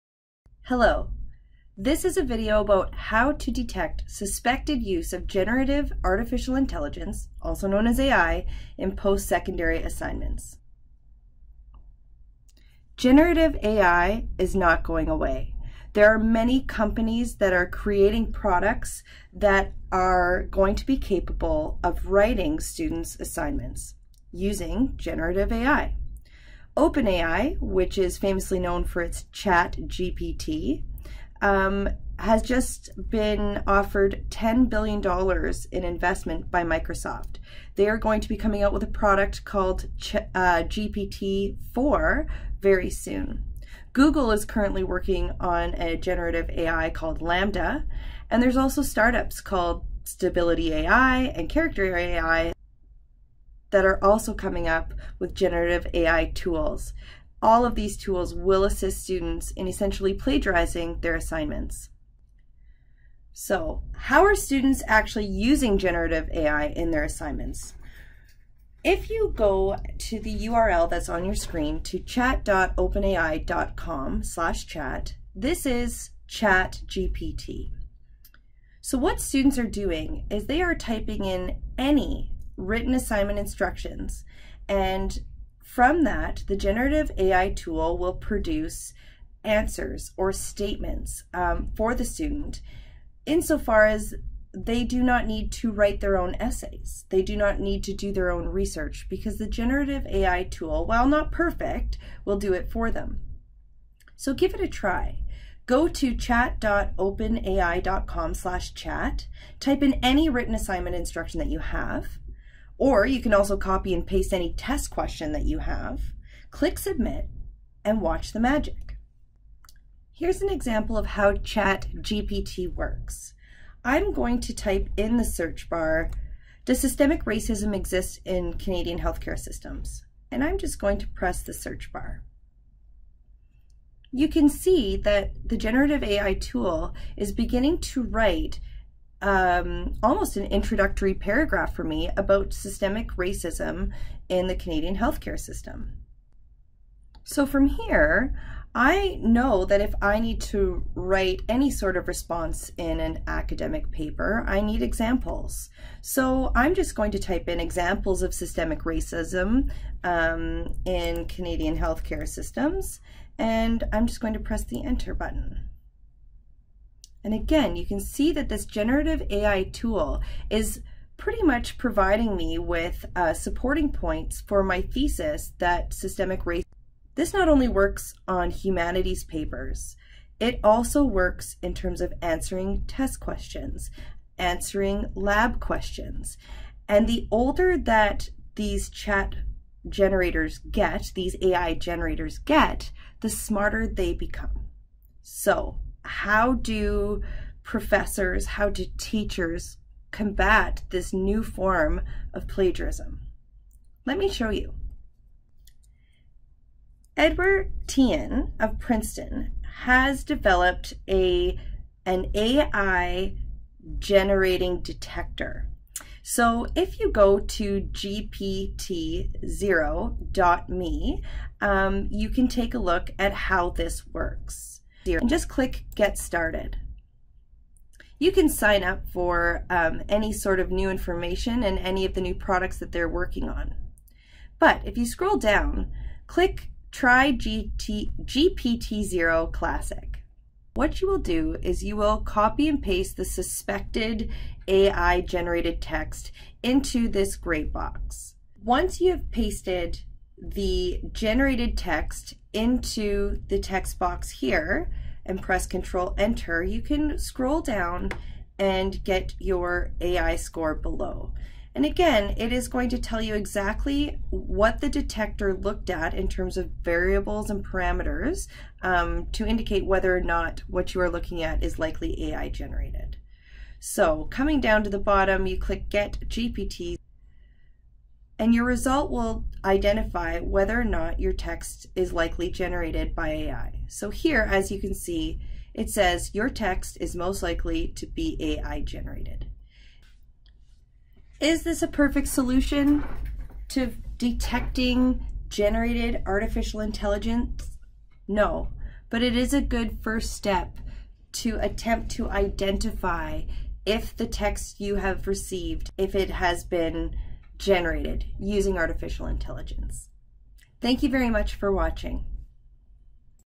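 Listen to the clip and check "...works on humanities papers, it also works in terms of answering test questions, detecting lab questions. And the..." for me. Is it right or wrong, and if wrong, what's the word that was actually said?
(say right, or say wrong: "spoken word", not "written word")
wrong: "answering", not "detecting".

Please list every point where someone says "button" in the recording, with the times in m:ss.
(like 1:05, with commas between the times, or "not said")
2:45.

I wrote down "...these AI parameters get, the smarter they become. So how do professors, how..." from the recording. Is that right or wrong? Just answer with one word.
wrong.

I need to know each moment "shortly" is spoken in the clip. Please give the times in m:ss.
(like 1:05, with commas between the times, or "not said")
not said.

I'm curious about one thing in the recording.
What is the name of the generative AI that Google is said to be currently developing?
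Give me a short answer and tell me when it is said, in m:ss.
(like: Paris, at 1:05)
LaMDA, at 0:47.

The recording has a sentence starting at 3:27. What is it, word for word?
Edward Tian of Princeton has developed a an AI generating detector.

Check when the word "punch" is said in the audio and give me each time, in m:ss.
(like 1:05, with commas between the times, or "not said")
not said.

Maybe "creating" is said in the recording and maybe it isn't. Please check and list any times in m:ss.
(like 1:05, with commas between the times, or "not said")
0:17.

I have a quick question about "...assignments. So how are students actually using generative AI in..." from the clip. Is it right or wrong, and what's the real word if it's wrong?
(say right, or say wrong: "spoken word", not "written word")
right.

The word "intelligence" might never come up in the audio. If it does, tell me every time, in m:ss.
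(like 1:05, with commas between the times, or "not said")
0:06, 4:56, 5:09.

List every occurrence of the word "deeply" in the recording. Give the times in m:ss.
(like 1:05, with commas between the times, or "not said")
not said.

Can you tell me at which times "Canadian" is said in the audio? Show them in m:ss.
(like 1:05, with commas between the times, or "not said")
2:08, 2:24, 2:41.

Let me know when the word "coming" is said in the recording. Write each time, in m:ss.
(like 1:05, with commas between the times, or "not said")
0:38, 0:54, 4:34.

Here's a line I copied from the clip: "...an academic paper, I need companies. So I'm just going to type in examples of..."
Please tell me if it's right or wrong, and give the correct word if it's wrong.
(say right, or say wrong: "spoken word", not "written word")
wrong: "examples", not "companies".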